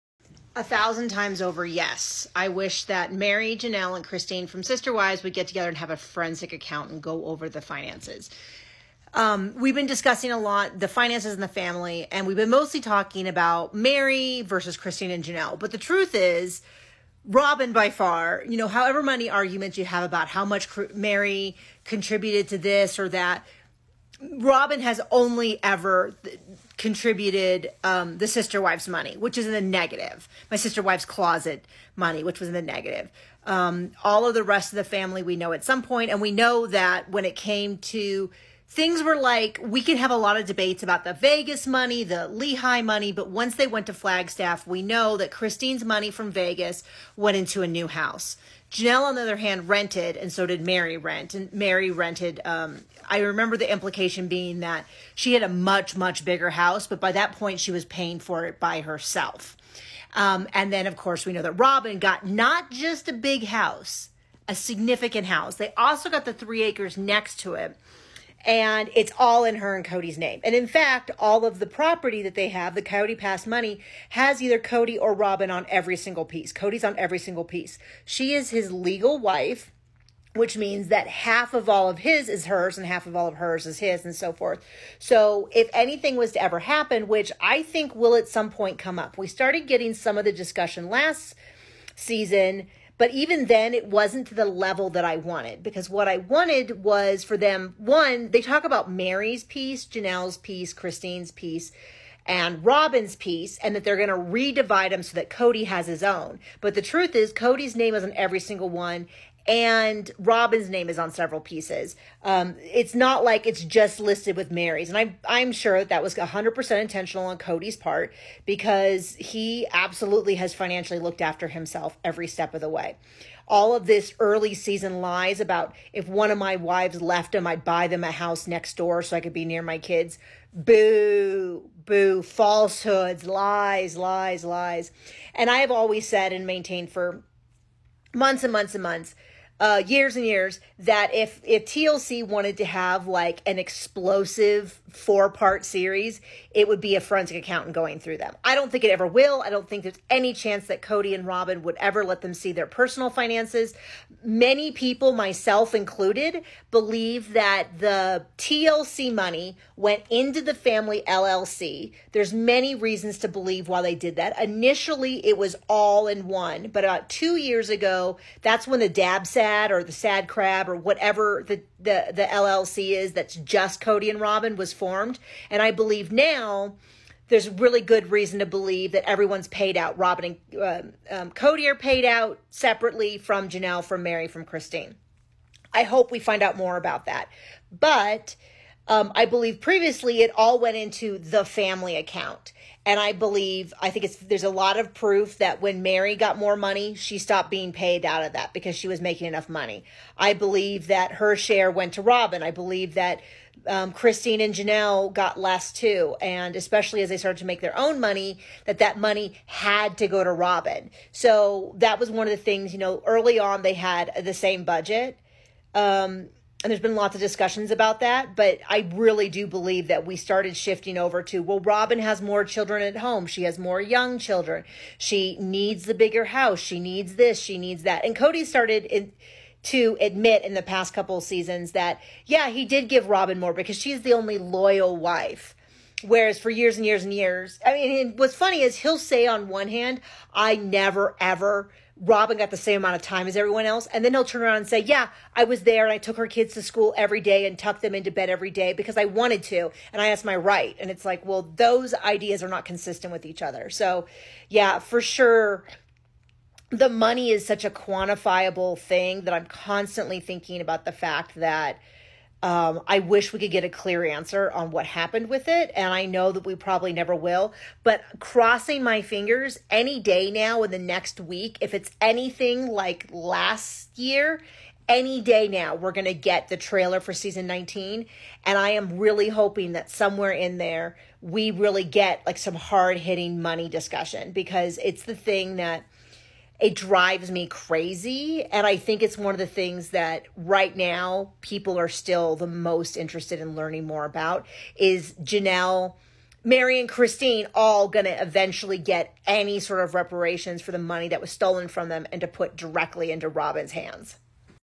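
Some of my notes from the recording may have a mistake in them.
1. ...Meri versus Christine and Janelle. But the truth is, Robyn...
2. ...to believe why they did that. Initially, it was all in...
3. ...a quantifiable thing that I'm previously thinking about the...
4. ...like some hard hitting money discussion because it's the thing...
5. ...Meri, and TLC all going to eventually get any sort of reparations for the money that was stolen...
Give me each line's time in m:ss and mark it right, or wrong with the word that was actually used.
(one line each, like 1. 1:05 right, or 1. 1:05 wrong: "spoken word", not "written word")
1. 0:13 right
2. 2:43 right
3. 4:17 wrong: "constantly", not "previously"
4. 4:42 right
5. 4:56 wrong: "Christine", not "TLC".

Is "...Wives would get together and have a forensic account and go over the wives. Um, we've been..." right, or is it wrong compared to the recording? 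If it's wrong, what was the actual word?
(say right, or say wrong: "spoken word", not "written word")
wrong: "finances", not "wives".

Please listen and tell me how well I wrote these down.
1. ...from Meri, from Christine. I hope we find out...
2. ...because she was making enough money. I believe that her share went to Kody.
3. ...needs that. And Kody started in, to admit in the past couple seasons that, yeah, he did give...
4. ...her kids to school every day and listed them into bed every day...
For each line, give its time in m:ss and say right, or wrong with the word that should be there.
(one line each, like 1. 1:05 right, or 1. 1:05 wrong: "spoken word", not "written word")
1. 3:03 right
2. 3:18 wrong: "Robyn", not "Kody"
3. 3:47 right
4. 4:06 wrong: "tucked", not "listed".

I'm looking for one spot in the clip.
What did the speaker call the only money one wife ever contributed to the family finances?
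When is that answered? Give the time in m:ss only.
0:30.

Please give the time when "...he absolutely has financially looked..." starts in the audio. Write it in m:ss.
1:59.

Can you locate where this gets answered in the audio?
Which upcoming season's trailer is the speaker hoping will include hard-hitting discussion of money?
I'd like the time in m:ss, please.
4:37.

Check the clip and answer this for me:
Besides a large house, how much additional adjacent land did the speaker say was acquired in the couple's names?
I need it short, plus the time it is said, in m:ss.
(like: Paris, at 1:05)
3 acres, at 1:06.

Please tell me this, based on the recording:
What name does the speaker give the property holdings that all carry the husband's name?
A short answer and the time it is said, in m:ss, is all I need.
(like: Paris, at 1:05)
Coyote Pass, at 1:12.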